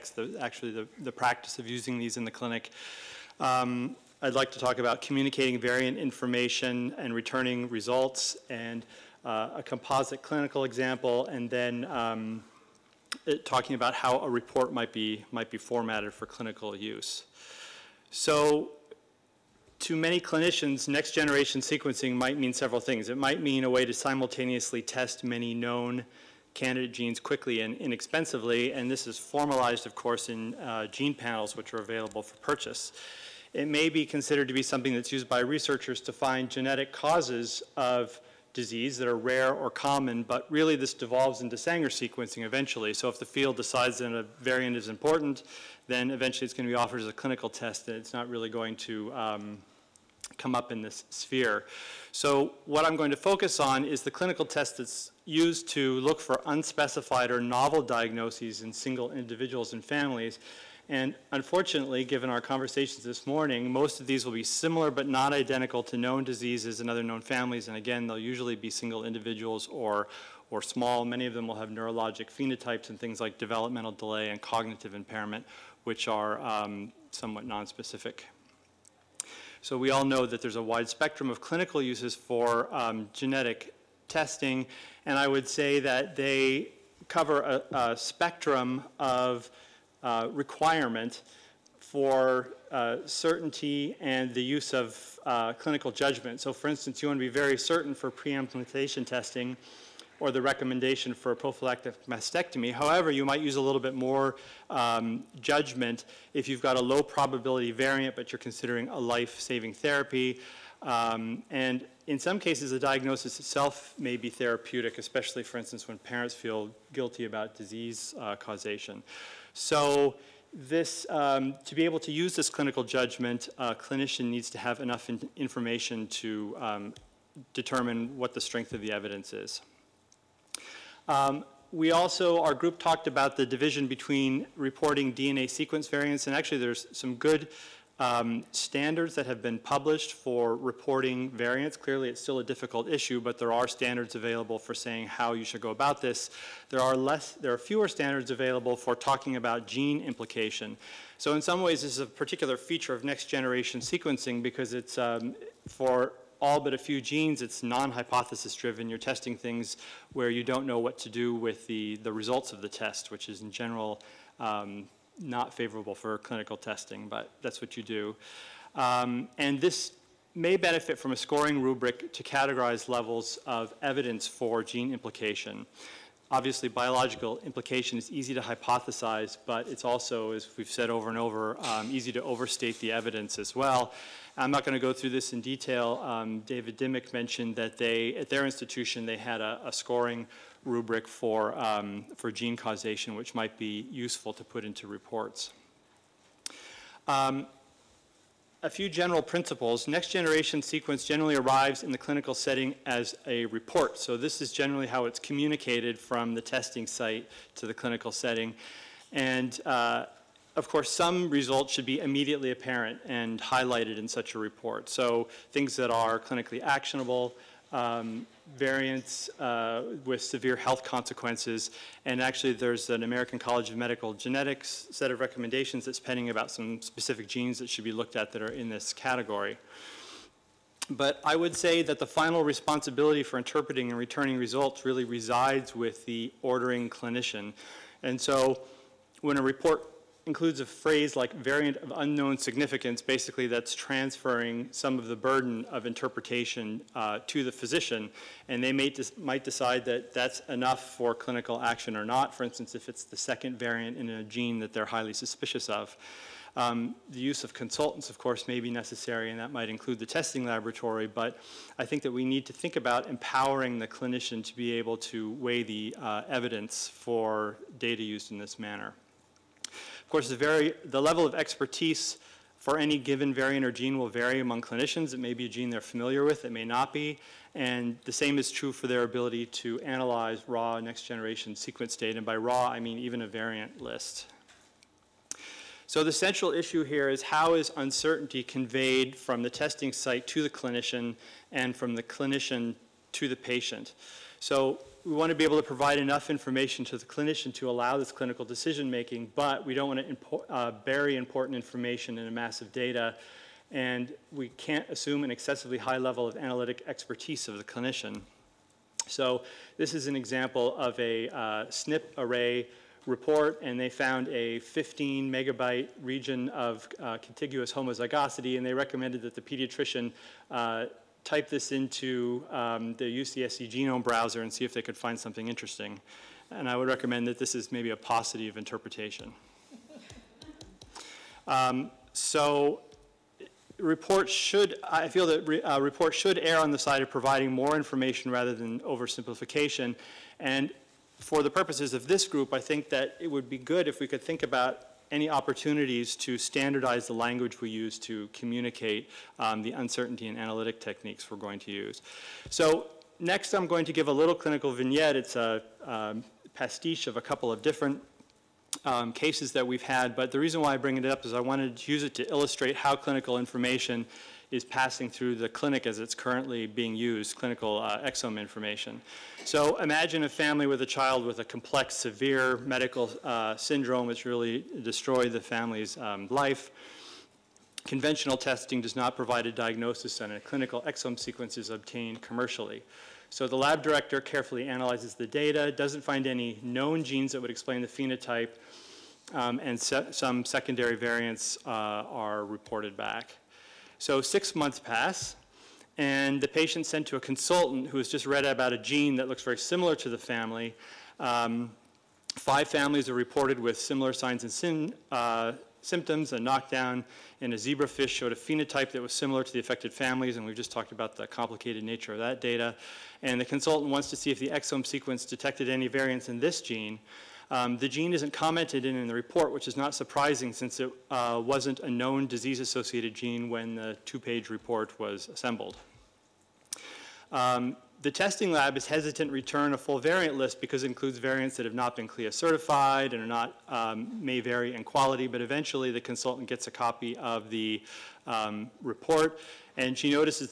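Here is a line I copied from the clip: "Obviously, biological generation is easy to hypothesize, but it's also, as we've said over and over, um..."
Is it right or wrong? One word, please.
wrong.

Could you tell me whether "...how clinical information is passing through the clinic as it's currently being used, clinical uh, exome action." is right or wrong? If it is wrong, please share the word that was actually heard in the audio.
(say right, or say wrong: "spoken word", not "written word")
wrong: "information", not "action".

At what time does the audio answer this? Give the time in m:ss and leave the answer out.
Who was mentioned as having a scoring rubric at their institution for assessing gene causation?
3:06.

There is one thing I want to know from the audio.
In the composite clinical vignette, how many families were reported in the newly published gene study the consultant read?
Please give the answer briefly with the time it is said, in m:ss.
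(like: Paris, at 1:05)
5, at 6:42.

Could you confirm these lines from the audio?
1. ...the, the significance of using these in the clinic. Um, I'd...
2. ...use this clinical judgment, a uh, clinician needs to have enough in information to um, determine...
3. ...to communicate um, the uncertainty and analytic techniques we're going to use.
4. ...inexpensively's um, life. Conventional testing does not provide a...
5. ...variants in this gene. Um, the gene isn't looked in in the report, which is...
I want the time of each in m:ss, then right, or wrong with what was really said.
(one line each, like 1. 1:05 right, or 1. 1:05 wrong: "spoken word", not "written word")
1. 0:00 wrong: "practice", not "significance"
2. 2:02 right
3. 5:47 right
4. 6:15 wrong: "family", not "inexpensively"
5. 6:55 wrong: "commented", not "looked".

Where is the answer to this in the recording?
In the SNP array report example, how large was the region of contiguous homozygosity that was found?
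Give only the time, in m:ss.
5:14.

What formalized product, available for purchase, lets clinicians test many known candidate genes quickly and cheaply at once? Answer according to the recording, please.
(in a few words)
Gene panels.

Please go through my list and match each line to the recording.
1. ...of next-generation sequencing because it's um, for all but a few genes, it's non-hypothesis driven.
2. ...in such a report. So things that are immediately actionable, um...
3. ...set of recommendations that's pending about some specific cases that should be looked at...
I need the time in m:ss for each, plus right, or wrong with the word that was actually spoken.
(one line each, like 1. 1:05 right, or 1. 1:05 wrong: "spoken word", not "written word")
1. 2:32 right
2. 3:33 wrong: "clinically", not "immediately"
3. 3:44 wrong: "genes", not "cases".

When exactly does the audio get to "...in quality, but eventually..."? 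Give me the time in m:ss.
7:14.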